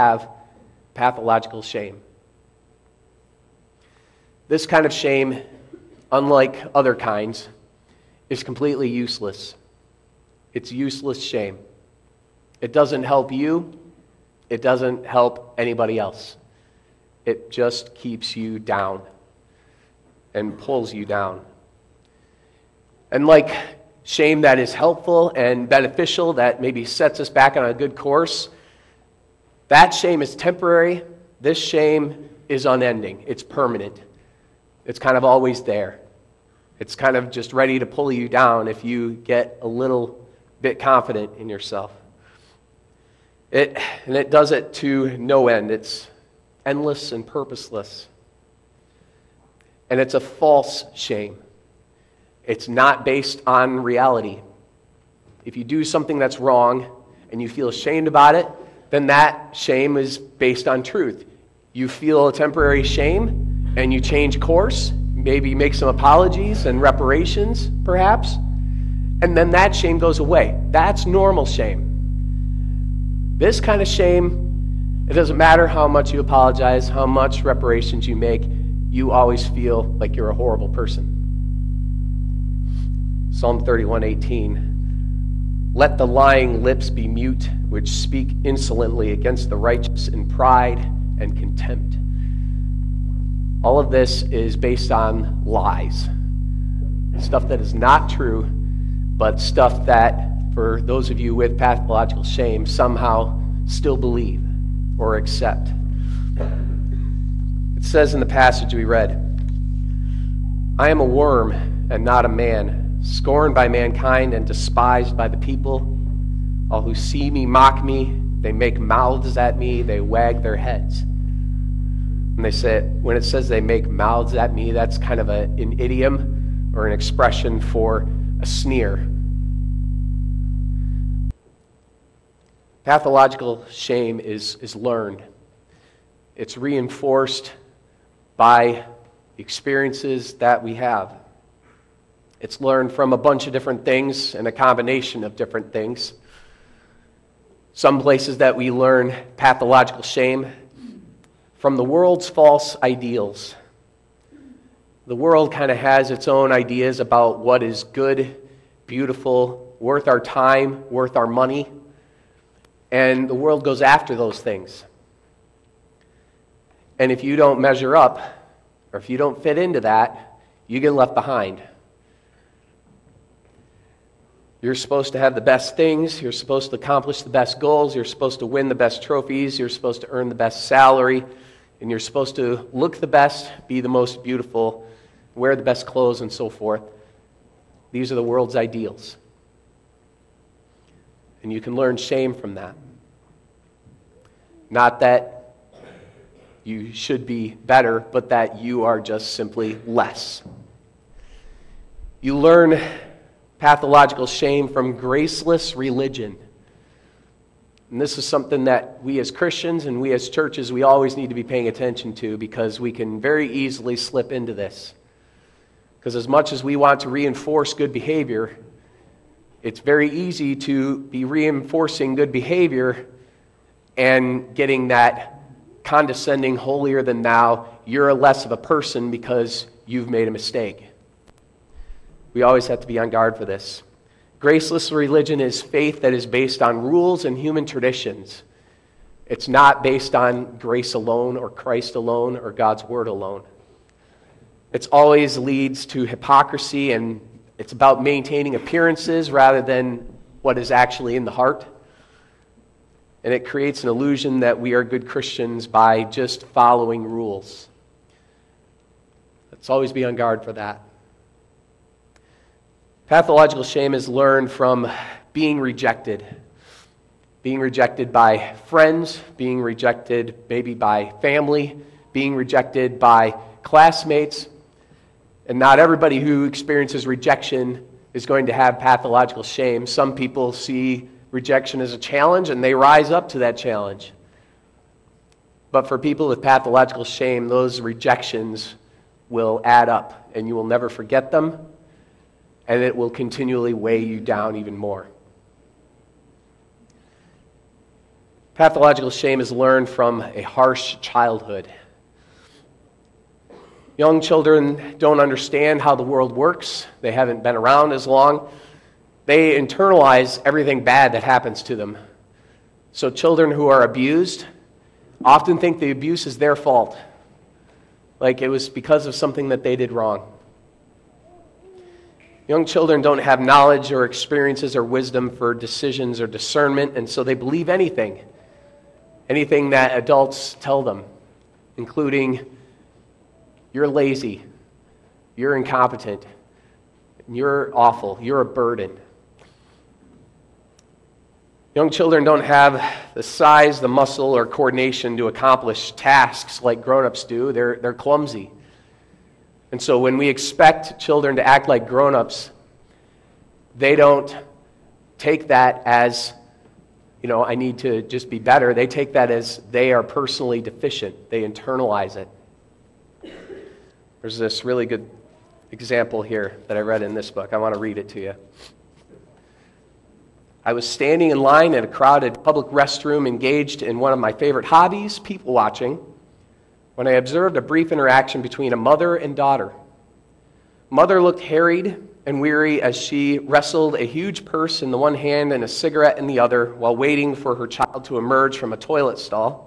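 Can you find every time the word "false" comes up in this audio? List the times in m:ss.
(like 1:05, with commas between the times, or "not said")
0:50, 2:32.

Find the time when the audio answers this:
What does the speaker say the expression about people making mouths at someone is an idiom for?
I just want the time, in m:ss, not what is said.
2:08.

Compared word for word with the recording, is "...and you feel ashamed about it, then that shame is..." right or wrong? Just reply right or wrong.
right.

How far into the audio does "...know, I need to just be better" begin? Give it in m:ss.
5:57.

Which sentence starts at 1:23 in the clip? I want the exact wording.
Psalm 31:18 Let the lying lips be mute which speak insolently against the righteous in pride and contempt.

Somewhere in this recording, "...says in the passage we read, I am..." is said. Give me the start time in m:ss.
1:47.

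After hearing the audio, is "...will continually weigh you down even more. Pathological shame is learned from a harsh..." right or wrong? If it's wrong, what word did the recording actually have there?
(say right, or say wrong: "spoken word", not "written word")
right.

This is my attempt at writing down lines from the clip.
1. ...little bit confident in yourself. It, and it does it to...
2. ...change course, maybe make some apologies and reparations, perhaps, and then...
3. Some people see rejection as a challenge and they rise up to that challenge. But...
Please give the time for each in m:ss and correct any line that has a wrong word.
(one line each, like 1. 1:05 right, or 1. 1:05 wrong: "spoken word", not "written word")
1. 0:39 right
2. 1:04 right
3. 4:39 right.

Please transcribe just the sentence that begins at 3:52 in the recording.
We always have to be on guard for this.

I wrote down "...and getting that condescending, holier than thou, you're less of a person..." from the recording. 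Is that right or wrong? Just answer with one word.
right.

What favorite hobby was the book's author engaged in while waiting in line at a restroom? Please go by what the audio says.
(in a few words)
people watching.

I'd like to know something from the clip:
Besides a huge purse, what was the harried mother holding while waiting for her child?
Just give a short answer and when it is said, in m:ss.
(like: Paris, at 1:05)
a cigarette, at 6:25.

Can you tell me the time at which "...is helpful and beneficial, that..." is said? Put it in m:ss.
0:24.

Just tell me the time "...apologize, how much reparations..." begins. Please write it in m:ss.
1:16.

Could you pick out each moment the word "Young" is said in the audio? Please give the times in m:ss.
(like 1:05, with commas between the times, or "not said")
5:03, 5:22, 5:41.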